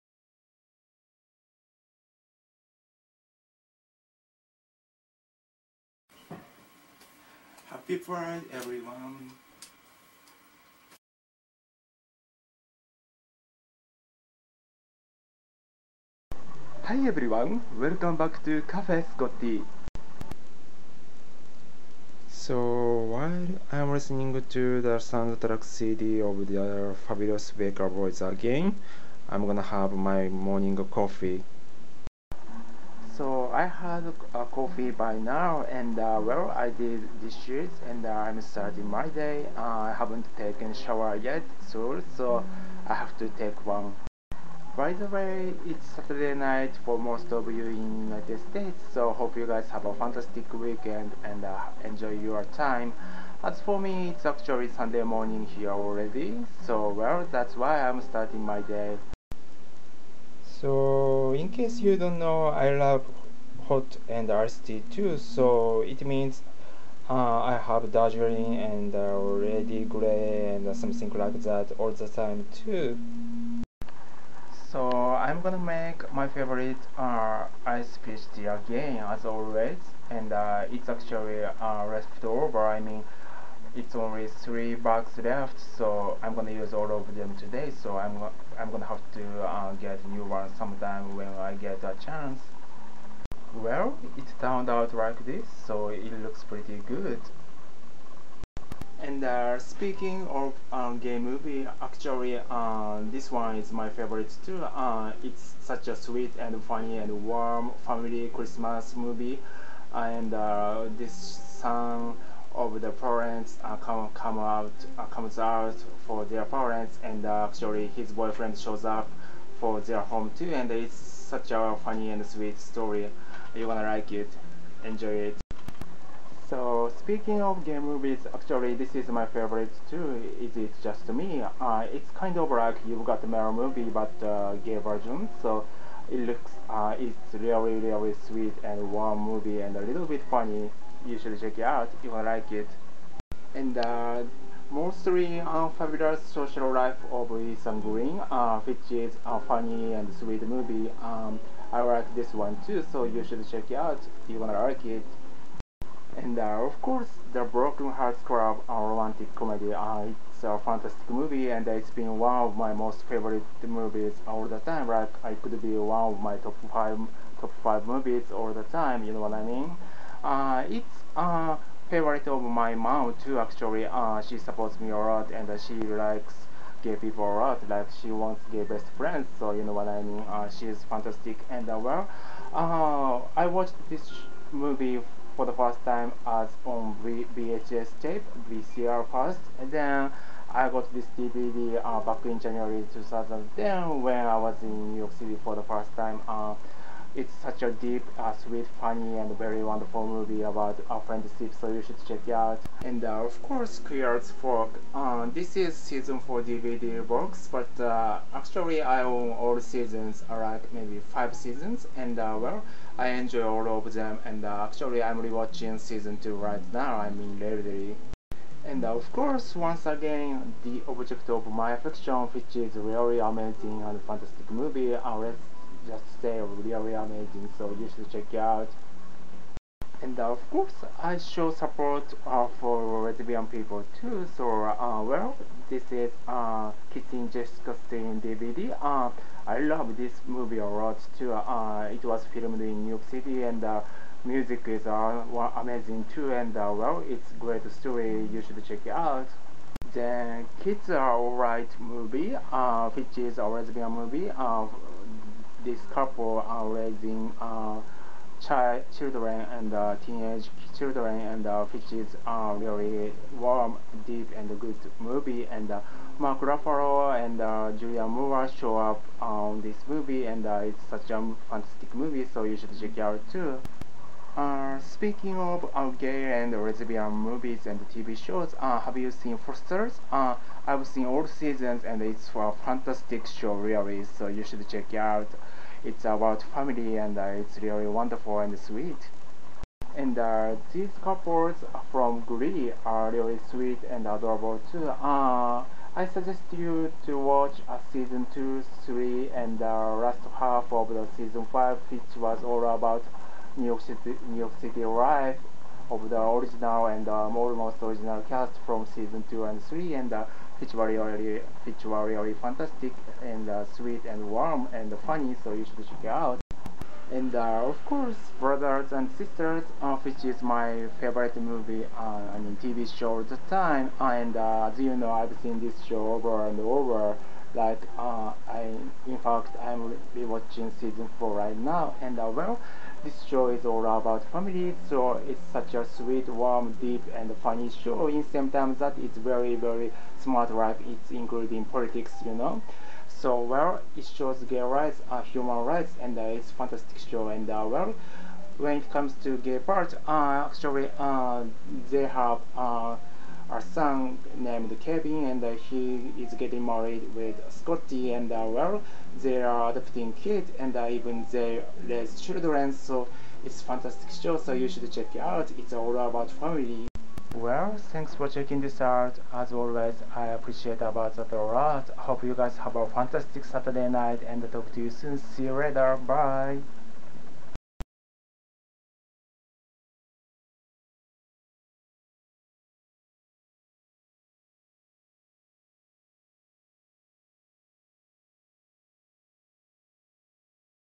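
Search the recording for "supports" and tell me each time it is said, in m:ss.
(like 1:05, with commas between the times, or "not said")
2:54, 3:51.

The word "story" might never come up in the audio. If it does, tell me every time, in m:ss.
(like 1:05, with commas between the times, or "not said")
2:02, 4:07.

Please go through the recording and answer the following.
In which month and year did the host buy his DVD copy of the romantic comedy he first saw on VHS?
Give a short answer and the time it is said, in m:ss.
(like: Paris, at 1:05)
January 2010, at 3:12.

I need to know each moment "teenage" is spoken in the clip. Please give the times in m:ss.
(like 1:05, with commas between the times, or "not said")
4:20.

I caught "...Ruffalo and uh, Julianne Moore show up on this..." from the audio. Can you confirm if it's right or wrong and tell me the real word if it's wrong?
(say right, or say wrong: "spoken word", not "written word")
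right.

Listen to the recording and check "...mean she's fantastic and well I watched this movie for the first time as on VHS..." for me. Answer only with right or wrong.
right.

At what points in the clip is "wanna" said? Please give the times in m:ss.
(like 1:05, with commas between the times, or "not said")
2:34.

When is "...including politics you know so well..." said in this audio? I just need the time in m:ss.
5:41.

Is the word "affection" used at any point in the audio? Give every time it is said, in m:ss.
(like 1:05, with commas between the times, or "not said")
3:41.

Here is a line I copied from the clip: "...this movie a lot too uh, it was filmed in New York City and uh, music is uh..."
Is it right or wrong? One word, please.
right.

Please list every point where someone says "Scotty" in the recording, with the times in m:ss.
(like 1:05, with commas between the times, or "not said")
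0:19, 5:57.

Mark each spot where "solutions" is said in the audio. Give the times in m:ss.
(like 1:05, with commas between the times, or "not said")
not said.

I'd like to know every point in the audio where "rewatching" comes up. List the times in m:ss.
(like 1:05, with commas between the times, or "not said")
3:35, 5:30.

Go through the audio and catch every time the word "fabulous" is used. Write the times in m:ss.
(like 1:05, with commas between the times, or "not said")
0:27, 2:25.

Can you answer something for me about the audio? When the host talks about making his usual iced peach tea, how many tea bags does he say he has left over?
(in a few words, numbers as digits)
3.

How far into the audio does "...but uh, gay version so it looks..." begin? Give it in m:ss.
2:13.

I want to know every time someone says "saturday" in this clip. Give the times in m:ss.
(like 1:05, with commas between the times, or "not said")
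0:45, 6:13.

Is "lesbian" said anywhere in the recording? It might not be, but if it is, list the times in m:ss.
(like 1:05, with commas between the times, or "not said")
3:53, 4:13, 4:36.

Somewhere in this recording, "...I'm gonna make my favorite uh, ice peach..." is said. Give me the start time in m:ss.
1:14.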